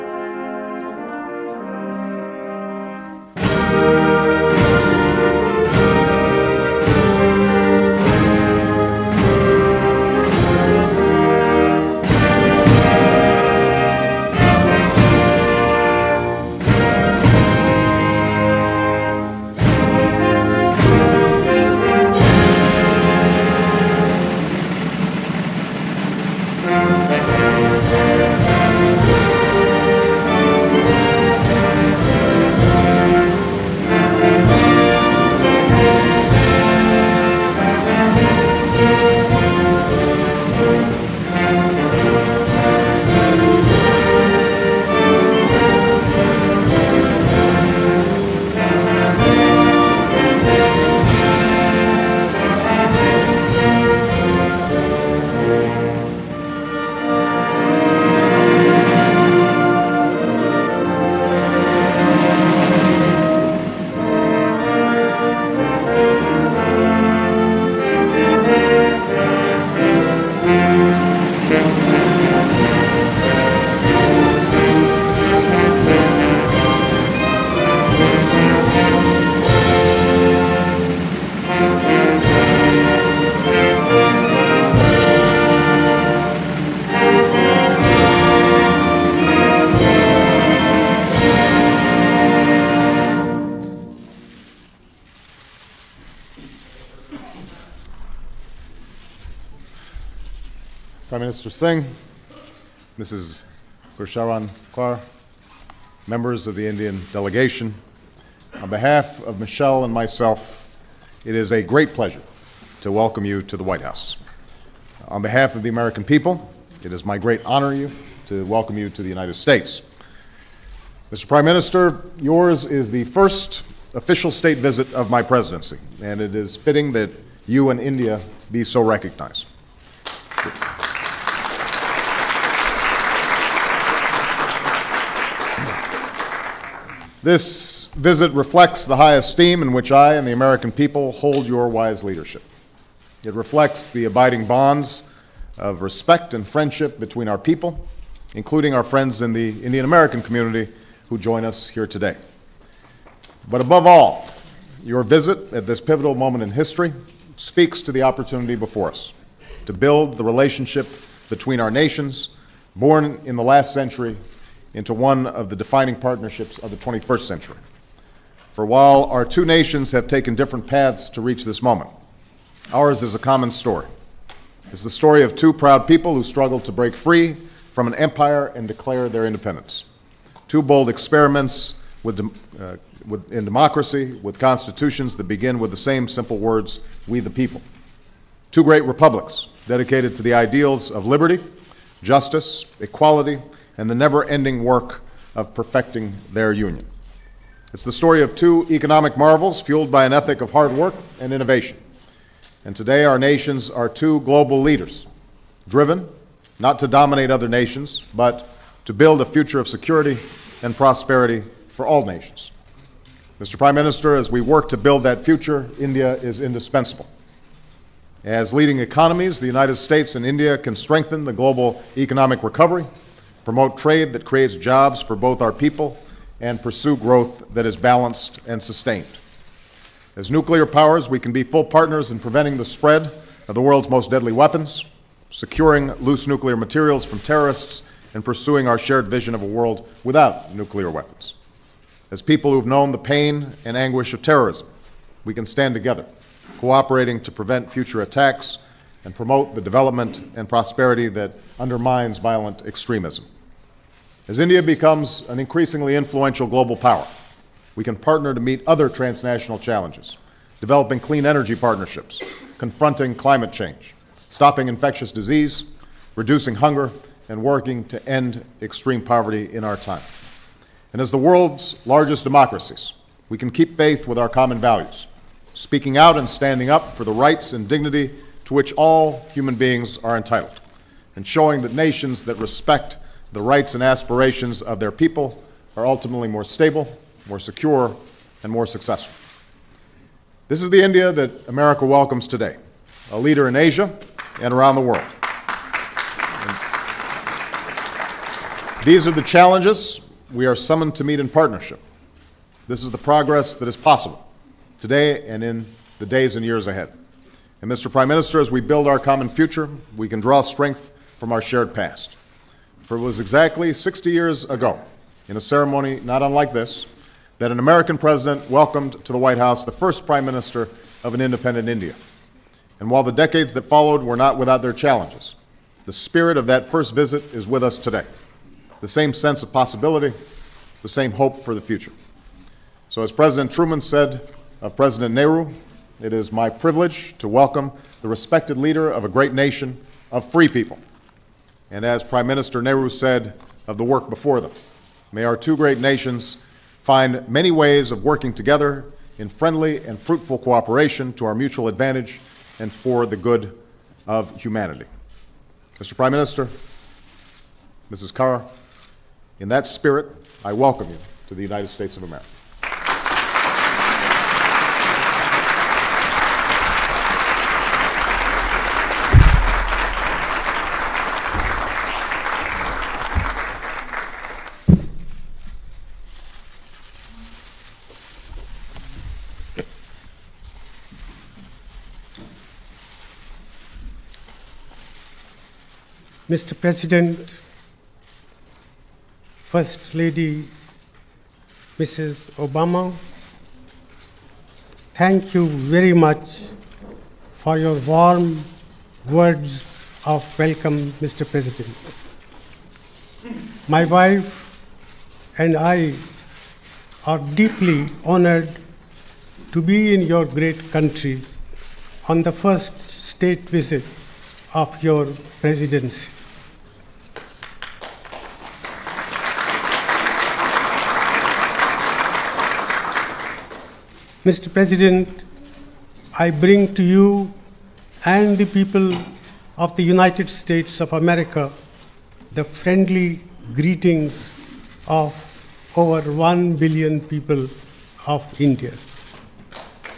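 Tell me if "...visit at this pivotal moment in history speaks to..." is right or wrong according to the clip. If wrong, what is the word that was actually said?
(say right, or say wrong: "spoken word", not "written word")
right.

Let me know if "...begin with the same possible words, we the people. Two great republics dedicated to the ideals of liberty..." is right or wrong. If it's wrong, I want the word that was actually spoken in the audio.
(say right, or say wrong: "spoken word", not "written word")
wrong: "simple", not "possible".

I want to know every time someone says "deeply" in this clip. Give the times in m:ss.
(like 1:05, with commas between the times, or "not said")
6:47.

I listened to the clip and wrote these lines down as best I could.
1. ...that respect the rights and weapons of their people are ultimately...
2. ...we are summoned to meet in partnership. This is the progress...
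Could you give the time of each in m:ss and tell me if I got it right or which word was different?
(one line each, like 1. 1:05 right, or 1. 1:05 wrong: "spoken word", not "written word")
1. 4:42 wrong: "aspirations", not "weapons"
2. 5:00 right.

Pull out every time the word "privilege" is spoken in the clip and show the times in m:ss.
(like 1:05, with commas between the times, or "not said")
5:36.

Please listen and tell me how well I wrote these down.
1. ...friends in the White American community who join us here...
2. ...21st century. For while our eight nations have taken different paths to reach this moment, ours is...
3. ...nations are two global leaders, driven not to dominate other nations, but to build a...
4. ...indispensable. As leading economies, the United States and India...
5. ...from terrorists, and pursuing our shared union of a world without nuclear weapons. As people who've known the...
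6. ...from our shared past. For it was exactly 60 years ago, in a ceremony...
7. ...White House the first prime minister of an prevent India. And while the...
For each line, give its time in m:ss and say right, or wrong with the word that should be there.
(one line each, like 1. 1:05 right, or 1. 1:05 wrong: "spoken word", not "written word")
1. 2:28 wrong: "Indian", not "White"
2. 2:46 wrong: "two", not "eight"
3. 3:23 right
4. 3:36 right
5. 3:57 wrong: "vision", not "union"
6. 5:11 right
7. 5:19 wrong: "independent", not "prevent".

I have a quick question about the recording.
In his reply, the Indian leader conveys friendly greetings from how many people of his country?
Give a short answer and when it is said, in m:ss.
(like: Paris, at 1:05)
Over 1 billion, at 7:15.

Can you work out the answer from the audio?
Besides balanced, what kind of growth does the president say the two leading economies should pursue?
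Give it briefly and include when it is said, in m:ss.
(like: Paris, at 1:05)
Sustained, at 3:48.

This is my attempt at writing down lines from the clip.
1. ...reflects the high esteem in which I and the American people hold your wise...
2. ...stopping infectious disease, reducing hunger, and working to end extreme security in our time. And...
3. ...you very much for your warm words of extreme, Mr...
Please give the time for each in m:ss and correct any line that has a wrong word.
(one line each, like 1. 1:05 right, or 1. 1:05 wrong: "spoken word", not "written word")
1. 2:18 right
2. 4:24 wrong: "poverty", not "security"
3. 6:35 wrong: "welcome", not "extreme".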